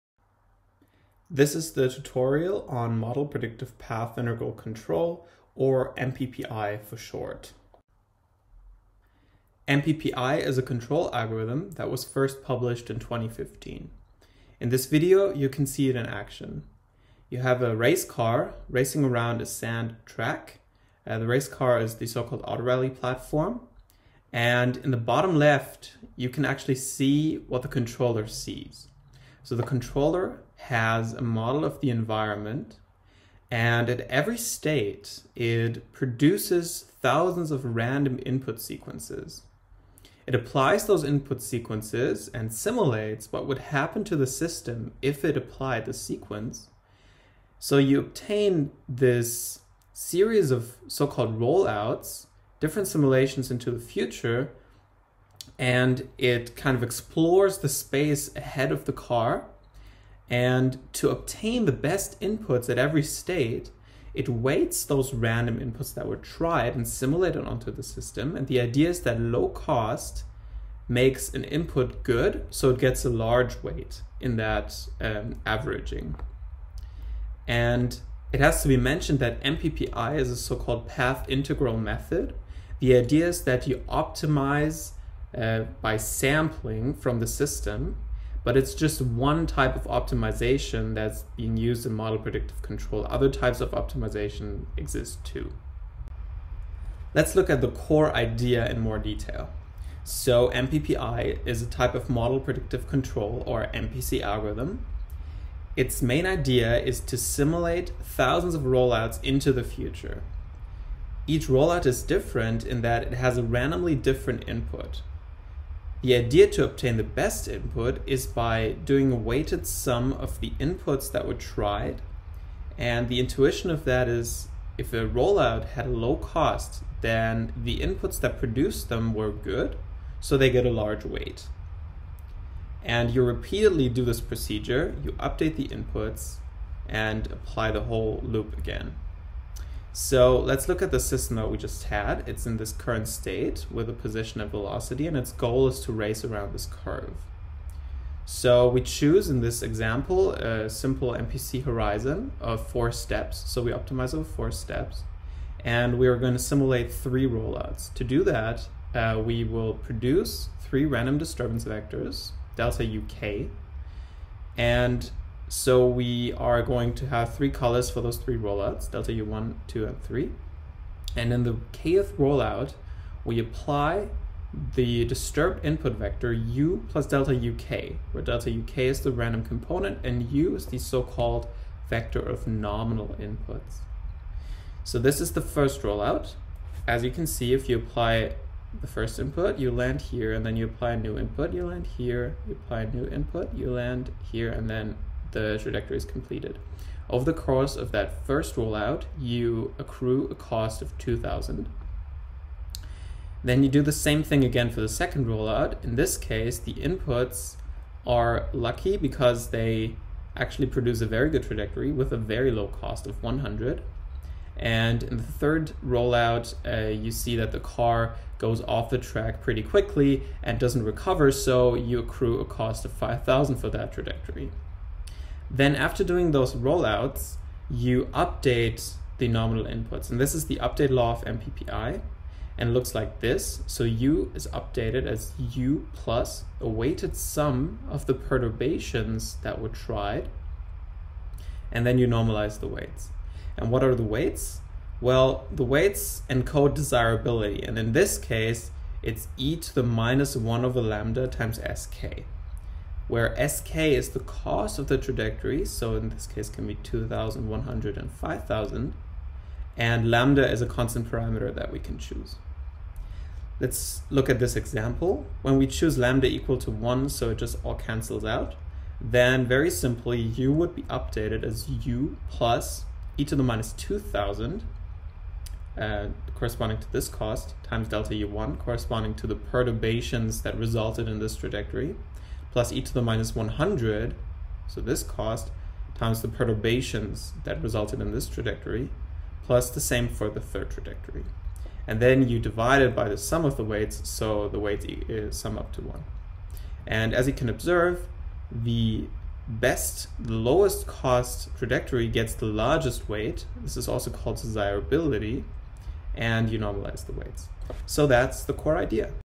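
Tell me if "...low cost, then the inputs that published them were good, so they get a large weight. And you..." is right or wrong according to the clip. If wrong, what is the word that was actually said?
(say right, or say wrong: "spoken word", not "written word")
wrong: "produced", not "published".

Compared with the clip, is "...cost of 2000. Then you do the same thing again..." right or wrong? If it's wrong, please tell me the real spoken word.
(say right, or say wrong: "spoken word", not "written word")
right.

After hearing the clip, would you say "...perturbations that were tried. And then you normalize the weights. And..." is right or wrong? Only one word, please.
right.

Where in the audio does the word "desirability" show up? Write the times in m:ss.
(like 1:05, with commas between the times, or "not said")
4:06, 5:04.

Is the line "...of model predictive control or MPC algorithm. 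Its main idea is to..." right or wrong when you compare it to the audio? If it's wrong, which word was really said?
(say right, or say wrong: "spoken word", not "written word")
right.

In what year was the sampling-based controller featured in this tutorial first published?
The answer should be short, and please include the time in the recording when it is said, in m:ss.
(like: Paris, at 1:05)
2015, at 0:12.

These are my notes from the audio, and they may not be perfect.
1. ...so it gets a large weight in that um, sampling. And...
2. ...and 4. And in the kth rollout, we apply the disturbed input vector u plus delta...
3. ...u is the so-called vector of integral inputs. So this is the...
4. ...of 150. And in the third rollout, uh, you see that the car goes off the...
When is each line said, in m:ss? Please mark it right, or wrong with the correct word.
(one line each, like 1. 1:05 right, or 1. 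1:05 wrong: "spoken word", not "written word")
1. 1:12 wrong: "averaging", not "sampling"
2. 2:49 wrong: "3", not "4"
3. 3:00 wrong: "nominal", not "integral"
4. 3:33 wrong: "100", not "150".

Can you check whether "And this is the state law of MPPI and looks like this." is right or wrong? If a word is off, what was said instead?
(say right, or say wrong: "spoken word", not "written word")
wrong: "update", not "state".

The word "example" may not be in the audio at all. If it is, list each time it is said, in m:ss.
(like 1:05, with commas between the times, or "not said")
2:29, 4:24.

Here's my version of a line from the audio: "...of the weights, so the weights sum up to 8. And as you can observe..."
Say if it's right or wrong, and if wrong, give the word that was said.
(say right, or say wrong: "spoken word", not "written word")
wrong: "1", not "8".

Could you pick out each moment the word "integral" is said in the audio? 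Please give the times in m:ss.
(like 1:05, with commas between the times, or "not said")
0:04, 1:21.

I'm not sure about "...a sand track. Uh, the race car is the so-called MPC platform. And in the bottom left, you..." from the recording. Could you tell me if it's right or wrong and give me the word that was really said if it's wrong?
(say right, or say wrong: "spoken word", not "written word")
wrong: "AutoRally", not "MPC".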